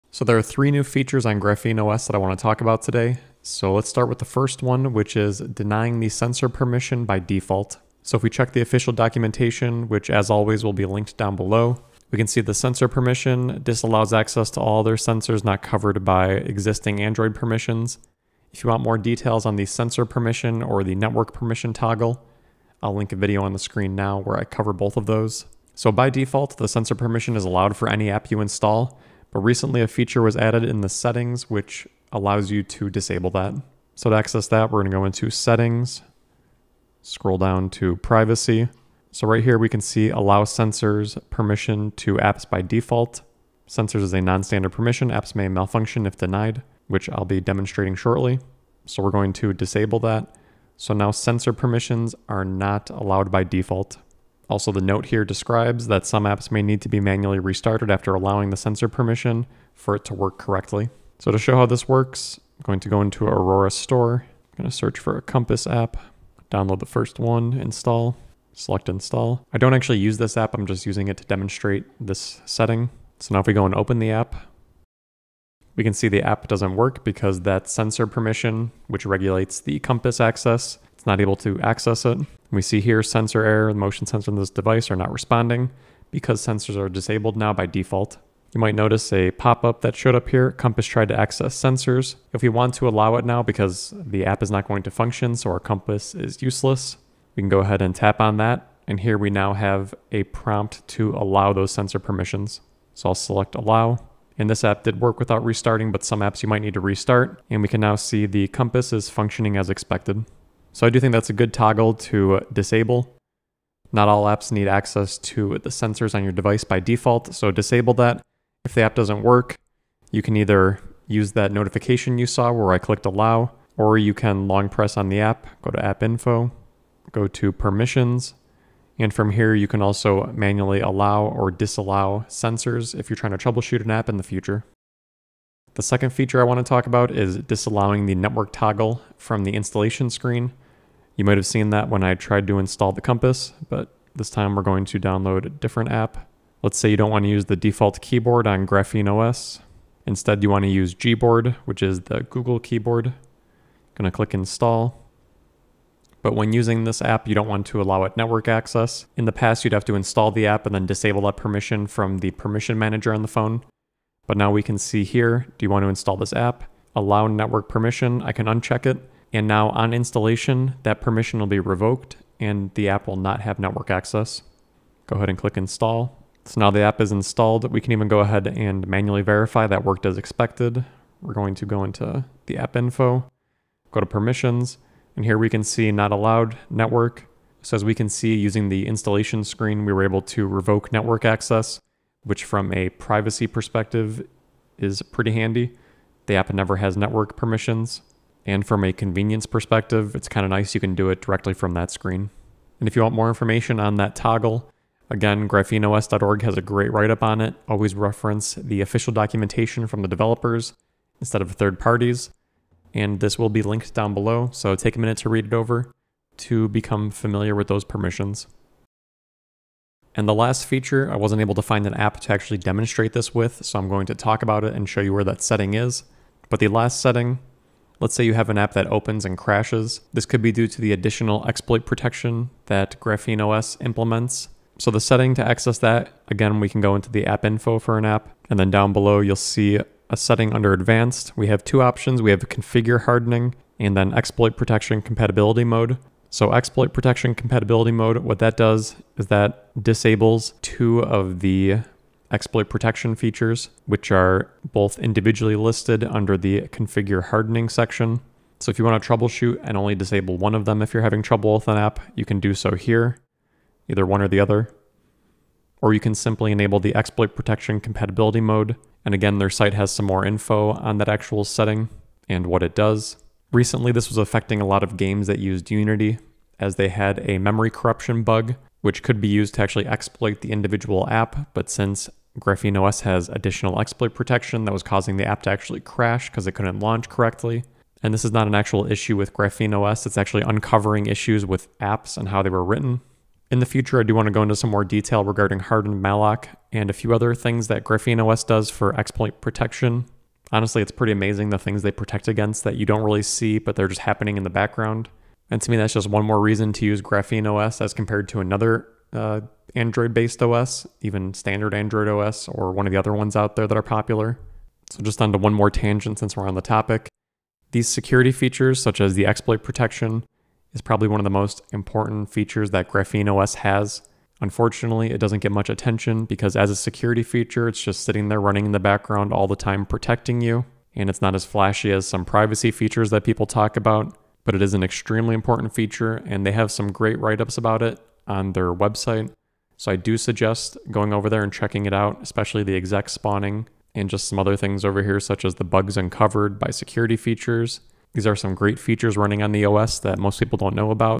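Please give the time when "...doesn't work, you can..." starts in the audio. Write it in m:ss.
1:58.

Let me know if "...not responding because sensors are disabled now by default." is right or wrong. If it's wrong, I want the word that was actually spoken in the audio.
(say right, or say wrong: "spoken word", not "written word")
right.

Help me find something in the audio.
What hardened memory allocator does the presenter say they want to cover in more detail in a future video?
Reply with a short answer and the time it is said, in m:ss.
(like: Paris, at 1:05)
hardened malloc, at 4:55.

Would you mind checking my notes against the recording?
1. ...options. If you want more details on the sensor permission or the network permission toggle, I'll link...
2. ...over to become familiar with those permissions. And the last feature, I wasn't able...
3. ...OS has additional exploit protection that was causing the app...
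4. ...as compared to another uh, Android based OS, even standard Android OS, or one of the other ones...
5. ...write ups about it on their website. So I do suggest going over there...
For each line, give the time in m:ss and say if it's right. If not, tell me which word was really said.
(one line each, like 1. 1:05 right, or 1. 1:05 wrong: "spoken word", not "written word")
1. 0:17 wrong: "permissions", not "options"
2. 3:35 right
3. 4:42 right
4. 5:07 right
5. 5:37 right.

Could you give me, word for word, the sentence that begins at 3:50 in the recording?
This could be due to the additional exploit protection that Graphene OS implements.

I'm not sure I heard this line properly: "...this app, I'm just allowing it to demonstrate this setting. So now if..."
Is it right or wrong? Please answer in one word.
wrong.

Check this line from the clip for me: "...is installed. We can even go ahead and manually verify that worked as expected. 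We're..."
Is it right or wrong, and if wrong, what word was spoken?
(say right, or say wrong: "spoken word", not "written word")
right.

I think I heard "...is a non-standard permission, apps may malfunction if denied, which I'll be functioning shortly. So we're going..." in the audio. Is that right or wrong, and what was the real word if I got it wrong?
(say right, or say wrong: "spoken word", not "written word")
wrong: "demonstrating", not "functioning".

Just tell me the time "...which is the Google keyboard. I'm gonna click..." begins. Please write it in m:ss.
2:31.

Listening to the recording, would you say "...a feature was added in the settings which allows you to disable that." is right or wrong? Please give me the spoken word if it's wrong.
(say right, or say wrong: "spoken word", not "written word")
right.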